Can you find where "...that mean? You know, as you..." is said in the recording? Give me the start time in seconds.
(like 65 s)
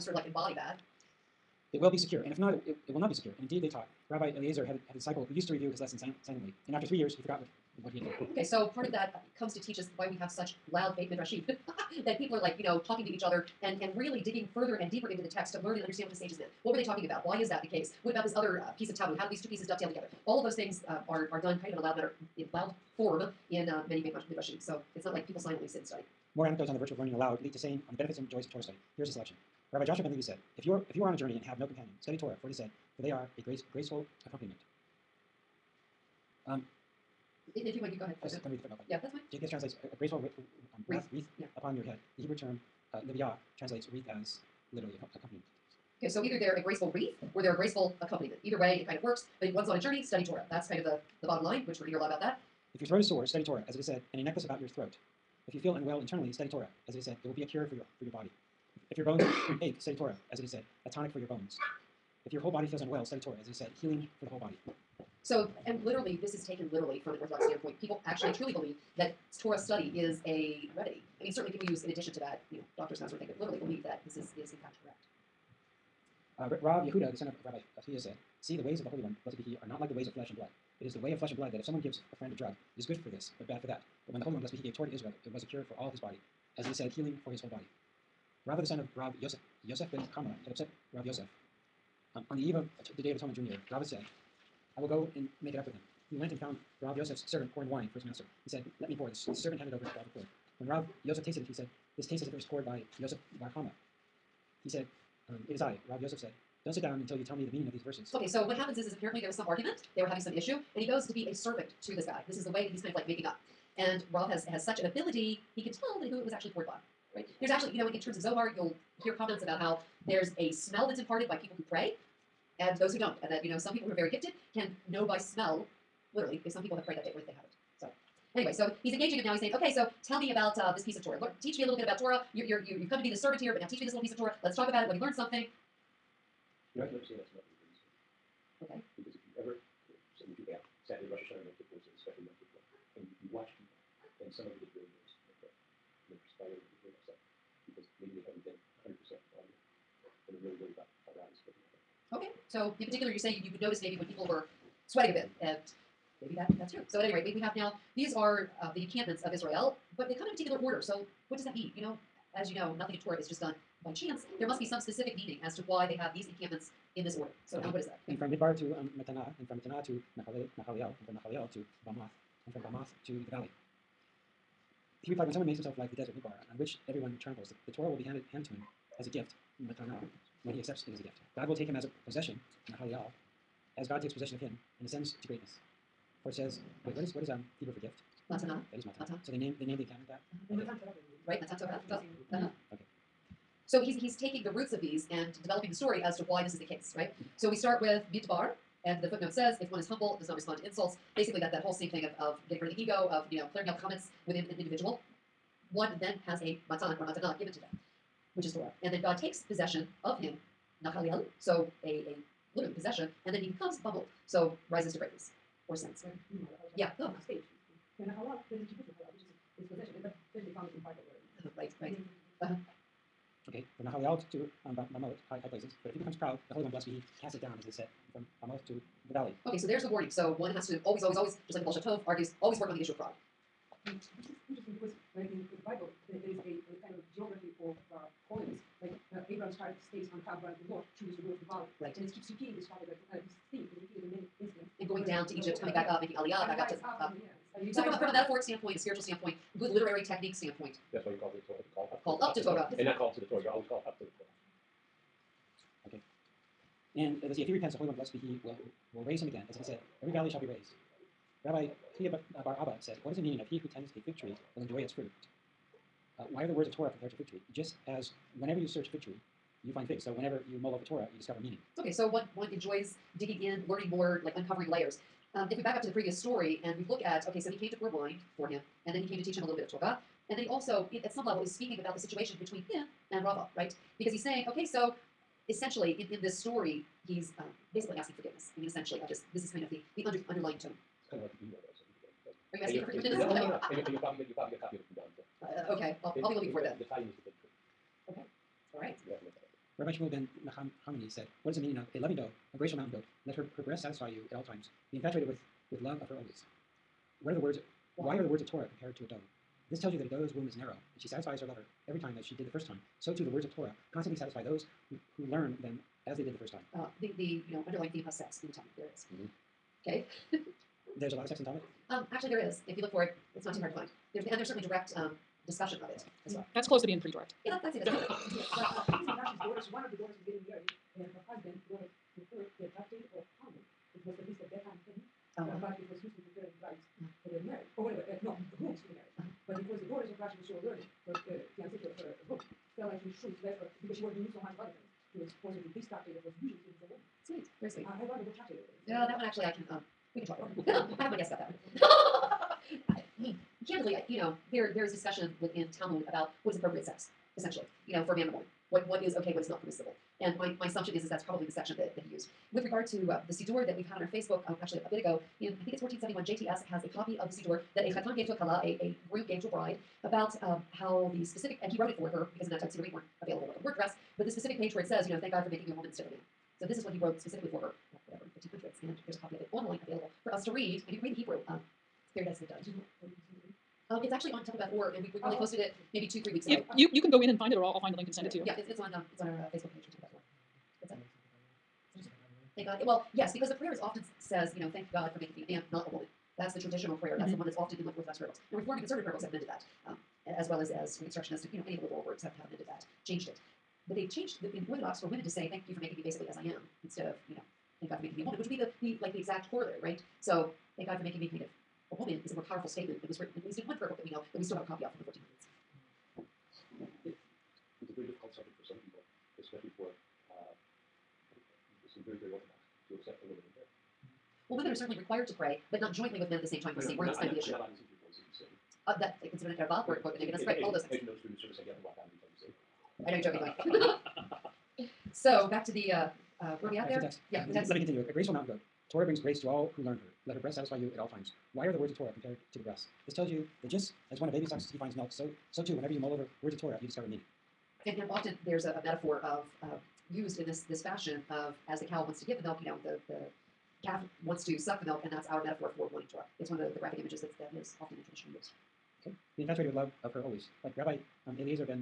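161 s.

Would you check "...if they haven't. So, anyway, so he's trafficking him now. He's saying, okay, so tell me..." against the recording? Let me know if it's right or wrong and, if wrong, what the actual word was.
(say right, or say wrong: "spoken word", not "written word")
wrong: "engaging", not "trafficking".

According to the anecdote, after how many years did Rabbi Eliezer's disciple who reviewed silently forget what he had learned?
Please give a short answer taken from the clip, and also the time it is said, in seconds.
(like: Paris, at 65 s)
3, at 6 s.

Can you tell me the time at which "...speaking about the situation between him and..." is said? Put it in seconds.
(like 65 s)
281 s.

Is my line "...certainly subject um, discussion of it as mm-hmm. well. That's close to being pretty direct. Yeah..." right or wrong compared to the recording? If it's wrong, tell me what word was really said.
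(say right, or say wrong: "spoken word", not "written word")
wrong: "direct", not "subject".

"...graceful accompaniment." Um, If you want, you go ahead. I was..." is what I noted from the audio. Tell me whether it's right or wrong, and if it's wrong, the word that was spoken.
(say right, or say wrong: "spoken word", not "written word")
right.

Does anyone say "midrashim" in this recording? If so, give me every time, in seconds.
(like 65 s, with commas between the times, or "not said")
11 s, 24 s.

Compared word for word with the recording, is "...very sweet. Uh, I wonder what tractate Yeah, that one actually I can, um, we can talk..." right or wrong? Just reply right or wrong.
right.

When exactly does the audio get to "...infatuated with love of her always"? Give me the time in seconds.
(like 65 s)
459 s.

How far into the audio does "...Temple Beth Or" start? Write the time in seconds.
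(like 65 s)
389 s.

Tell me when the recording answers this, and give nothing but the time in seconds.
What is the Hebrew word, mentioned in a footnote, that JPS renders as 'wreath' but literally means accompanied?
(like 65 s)
43 s.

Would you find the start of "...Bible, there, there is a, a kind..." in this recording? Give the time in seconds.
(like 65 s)
235 s.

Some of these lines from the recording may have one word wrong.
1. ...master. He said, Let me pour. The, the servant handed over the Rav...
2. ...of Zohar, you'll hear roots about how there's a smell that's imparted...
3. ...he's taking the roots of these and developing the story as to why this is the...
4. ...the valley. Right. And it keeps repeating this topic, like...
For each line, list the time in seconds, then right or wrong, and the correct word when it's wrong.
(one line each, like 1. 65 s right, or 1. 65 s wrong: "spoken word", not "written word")
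1. 98 s right
2. 118 s wrong: "comments", not "roots"
3. 194 s right
4. 241 s right.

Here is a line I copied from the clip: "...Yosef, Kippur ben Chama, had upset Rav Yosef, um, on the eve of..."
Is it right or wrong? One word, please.
wrong.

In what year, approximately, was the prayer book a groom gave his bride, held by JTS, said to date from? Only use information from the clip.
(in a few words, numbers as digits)
1471.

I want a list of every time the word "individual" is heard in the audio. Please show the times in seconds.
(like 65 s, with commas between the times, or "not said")
204 s.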